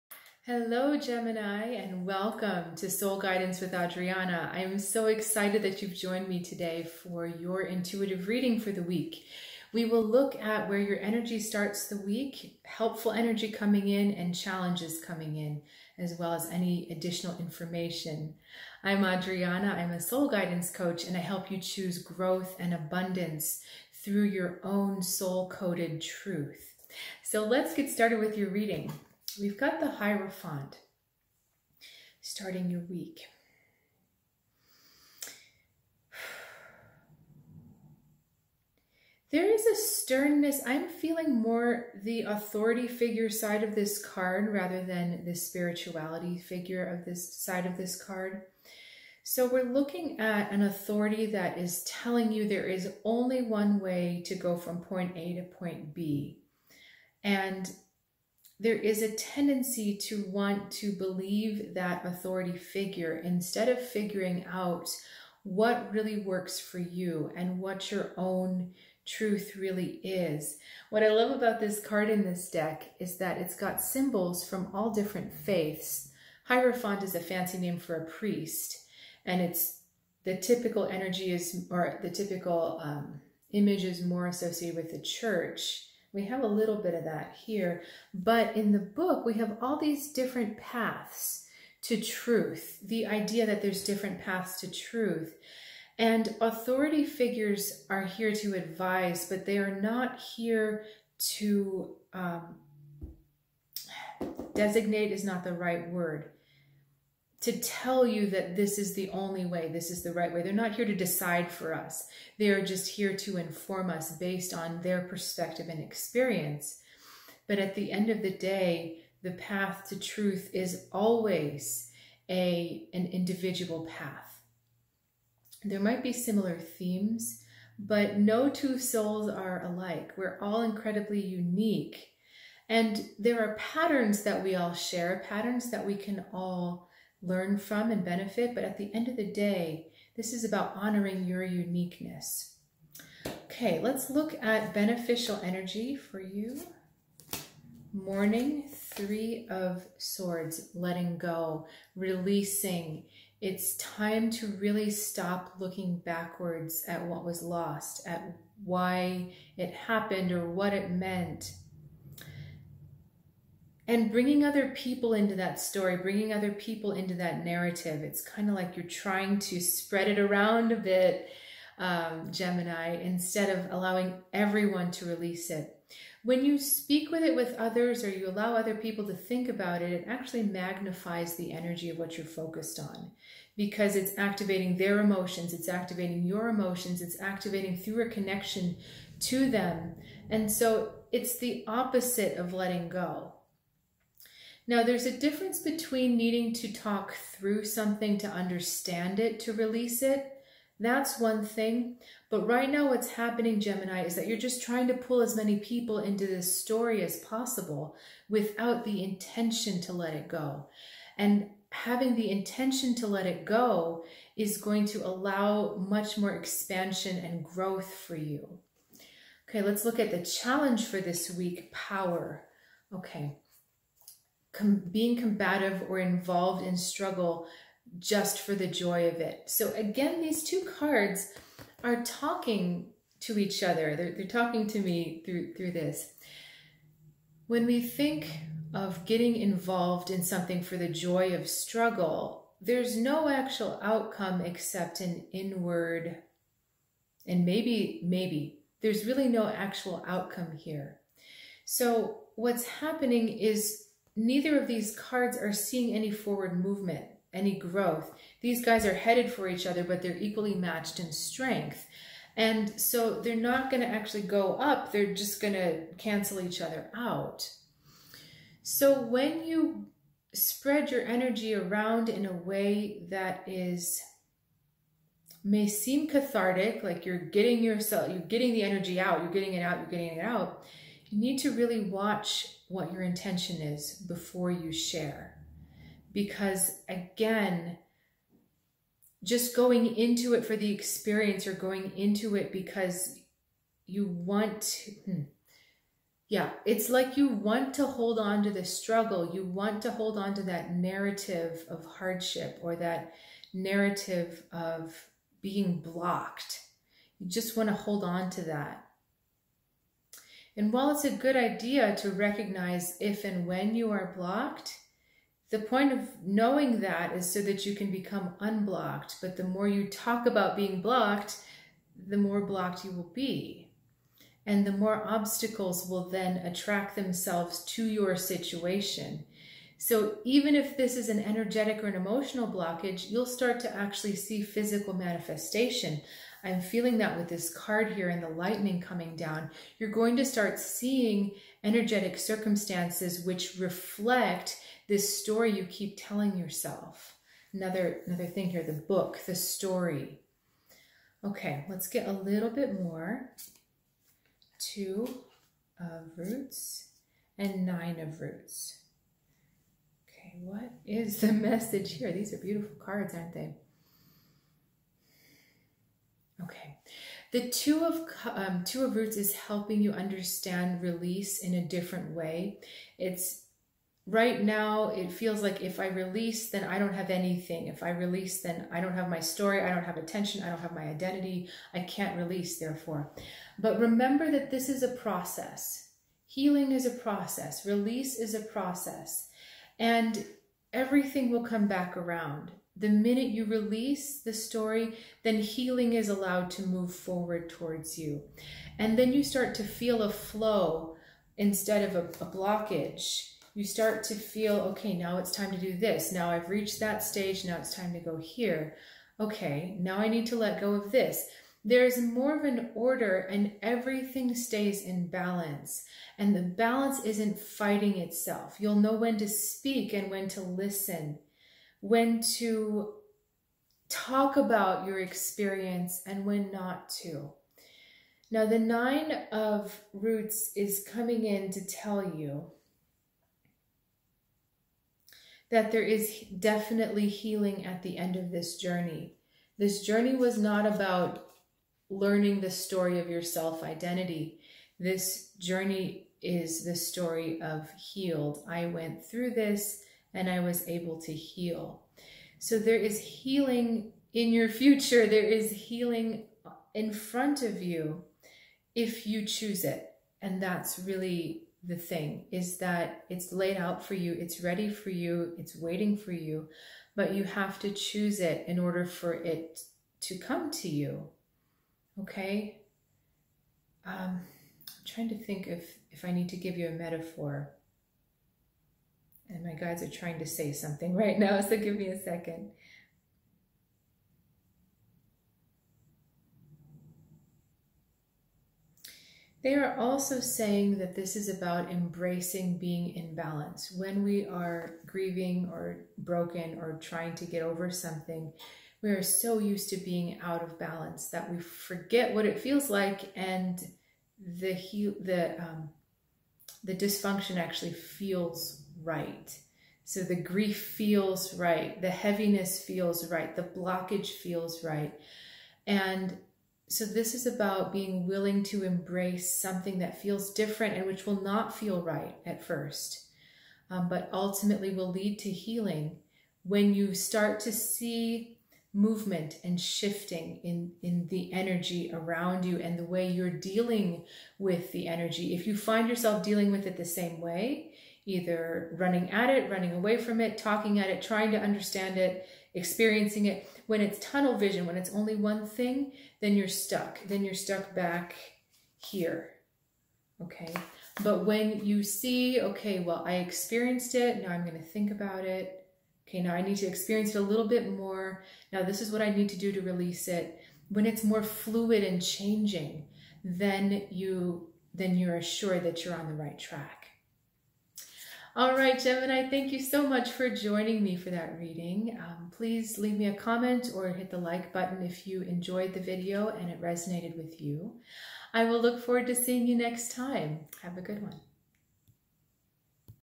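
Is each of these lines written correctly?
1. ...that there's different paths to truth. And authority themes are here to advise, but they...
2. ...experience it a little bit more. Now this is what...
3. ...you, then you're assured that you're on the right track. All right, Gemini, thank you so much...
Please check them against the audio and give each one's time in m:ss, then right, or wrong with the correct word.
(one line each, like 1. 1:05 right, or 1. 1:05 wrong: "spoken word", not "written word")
1. 1:33 wrong: "figures", not "themes"
2. 9:16 right
3. 9:23 right.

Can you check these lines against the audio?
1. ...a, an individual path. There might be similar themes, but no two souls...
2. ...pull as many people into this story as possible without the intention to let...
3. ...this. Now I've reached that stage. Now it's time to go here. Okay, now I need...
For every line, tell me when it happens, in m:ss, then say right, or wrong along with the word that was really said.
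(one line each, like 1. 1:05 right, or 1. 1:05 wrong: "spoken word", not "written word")
1. 2:02 right
2. 3:24 right
3. 6:45 right.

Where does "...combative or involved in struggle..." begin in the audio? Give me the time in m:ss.
3:45.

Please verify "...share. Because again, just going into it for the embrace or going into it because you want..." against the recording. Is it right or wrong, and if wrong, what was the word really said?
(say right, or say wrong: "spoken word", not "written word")
wrong: "experience", not "embrace".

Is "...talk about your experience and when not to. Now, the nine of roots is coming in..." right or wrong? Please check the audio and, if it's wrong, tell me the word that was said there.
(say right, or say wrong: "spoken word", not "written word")
right.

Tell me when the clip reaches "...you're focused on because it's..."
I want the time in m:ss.
3:02.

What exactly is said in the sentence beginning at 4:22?
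And so they're not going to actually go up.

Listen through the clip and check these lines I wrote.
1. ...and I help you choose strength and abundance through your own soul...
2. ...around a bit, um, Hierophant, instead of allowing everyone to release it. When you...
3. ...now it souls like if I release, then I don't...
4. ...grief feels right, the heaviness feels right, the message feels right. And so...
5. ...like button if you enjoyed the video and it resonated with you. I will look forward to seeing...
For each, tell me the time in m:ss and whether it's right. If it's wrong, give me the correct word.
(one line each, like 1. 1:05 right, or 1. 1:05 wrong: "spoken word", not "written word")
1. 0:21 wrong: "growth", not "strength"
2. 2:50 wrong: "Gemini", not "Hierophant"
3. 6:14 wrong: "feels", not "souls"
4. 8:30 wrong: "blockage", not "message"
5. 9:34 right.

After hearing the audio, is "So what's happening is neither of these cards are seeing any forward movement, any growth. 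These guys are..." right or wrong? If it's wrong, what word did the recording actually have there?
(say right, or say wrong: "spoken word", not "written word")
right.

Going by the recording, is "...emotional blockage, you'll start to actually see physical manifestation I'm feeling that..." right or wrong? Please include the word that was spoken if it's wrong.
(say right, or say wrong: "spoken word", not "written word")
right.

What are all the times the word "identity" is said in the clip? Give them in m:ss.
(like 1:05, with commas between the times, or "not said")
6:20, 7:23.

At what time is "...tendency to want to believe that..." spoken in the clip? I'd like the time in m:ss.
0:59.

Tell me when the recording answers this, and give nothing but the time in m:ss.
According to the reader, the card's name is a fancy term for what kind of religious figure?
1:17.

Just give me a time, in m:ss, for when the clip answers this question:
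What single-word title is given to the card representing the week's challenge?
3:41.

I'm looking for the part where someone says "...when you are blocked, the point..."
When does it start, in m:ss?
5:13.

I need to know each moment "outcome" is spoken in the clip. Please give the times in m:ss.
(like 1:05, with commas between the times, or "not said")
4:03, 4:10.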